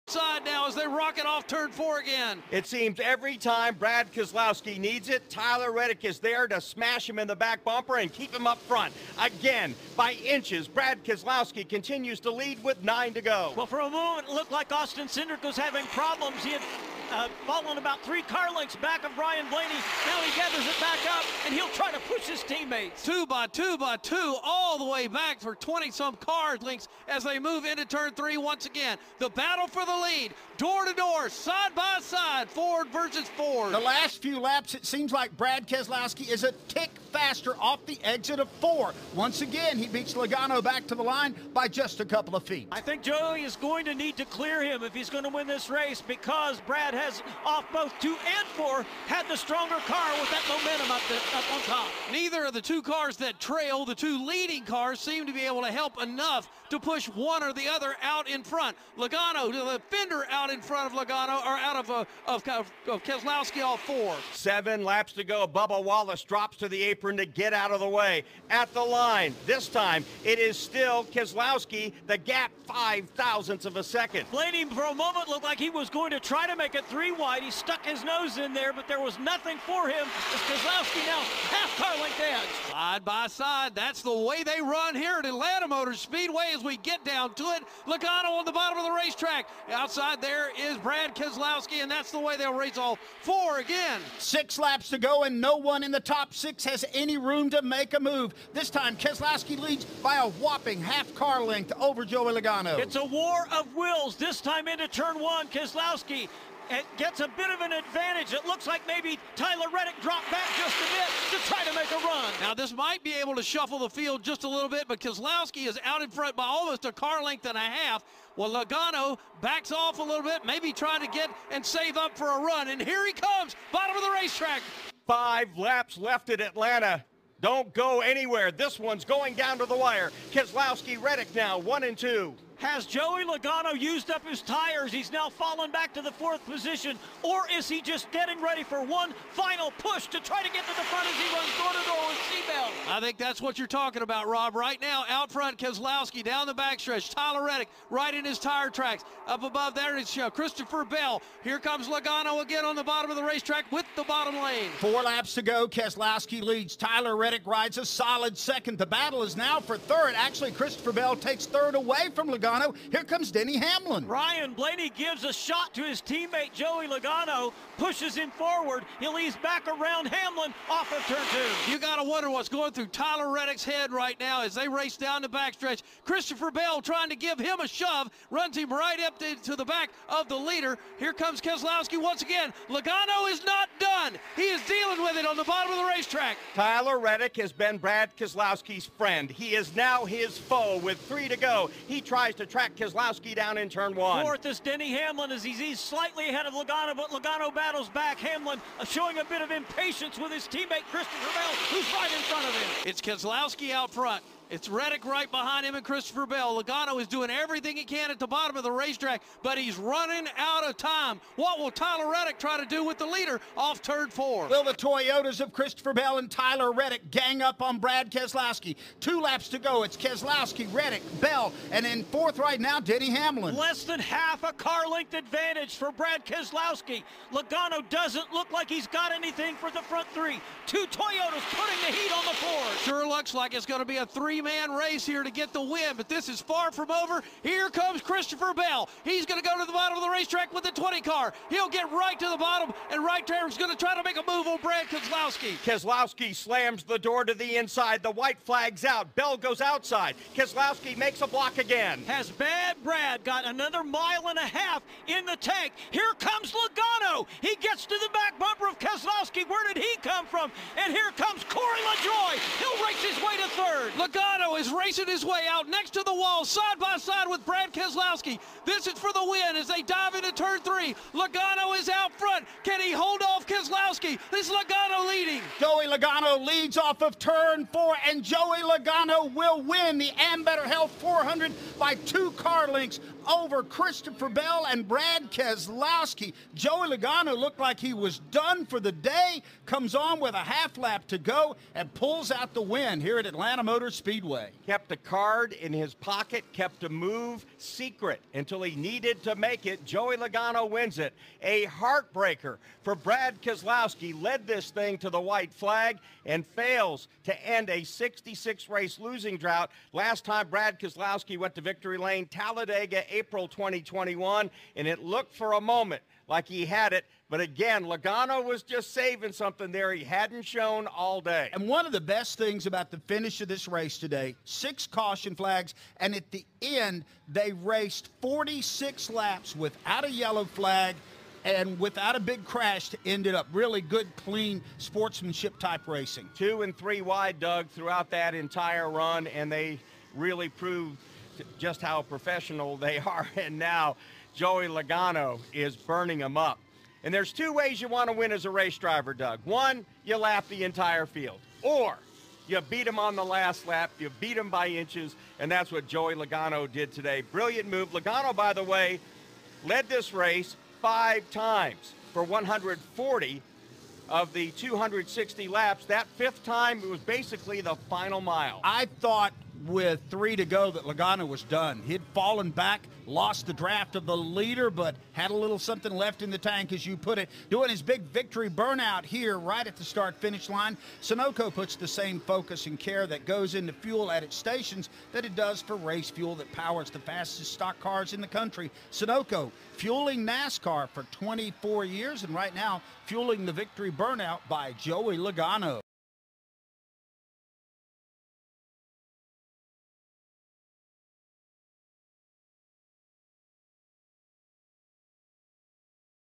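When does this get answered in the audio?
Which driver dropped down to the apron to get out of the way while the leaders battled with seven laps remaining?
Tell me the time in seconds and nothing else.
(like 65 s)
65 s.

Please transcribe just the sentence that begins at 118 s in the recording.
Well, Logano backs off a little bit, maybe trying to get and save up for a run.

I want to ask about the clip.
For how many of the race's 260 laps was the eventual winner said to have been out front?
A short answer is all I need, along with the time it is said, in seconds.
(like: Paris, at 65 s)
140, at 362 s.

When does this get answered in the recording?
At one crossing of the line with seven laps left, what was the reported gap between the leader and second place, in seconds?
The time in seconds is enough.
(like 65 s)
72 s.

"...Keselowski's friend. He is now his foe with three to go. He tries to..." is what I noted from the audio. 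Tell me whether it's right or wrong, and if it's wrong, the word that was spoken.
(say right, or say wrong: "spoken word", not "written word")
right.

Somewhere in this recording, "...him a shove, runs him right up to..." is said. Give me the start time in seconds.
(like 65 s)
177 s.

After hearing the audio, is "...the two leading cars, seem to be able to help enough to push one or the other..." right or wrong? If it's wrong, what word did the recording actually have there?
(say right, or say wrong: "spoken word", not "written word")
right.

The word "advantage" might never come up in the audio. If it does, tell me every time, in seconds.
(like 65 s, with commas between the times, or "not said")
107 s, 225 s.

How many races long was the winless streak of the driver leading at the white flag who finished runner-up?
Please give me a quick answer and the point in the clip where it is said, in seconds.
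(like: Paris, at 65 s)
66, at 307 s.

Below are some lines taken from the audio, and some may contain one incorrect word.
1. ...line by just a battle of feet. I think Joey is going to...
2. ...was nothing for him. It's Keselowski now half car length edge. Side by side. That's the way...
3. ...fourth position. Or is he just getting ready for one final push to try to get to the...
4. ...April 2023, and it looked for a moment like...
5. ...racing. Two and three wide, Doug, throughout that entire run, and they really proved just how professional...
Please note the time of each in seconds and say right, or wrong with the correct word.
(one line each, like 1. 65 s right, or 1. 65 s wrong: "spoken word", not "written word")
1. 41 s wrong: "couple", not "battle"
2. 78 s right
3. 136 s right
4. 313 s wrong: "2021", not "2023"
5. 335 s right.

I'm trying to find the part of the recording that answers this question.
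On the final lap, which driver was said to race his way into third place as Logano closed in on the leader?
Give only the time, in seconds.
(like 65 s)
261 s.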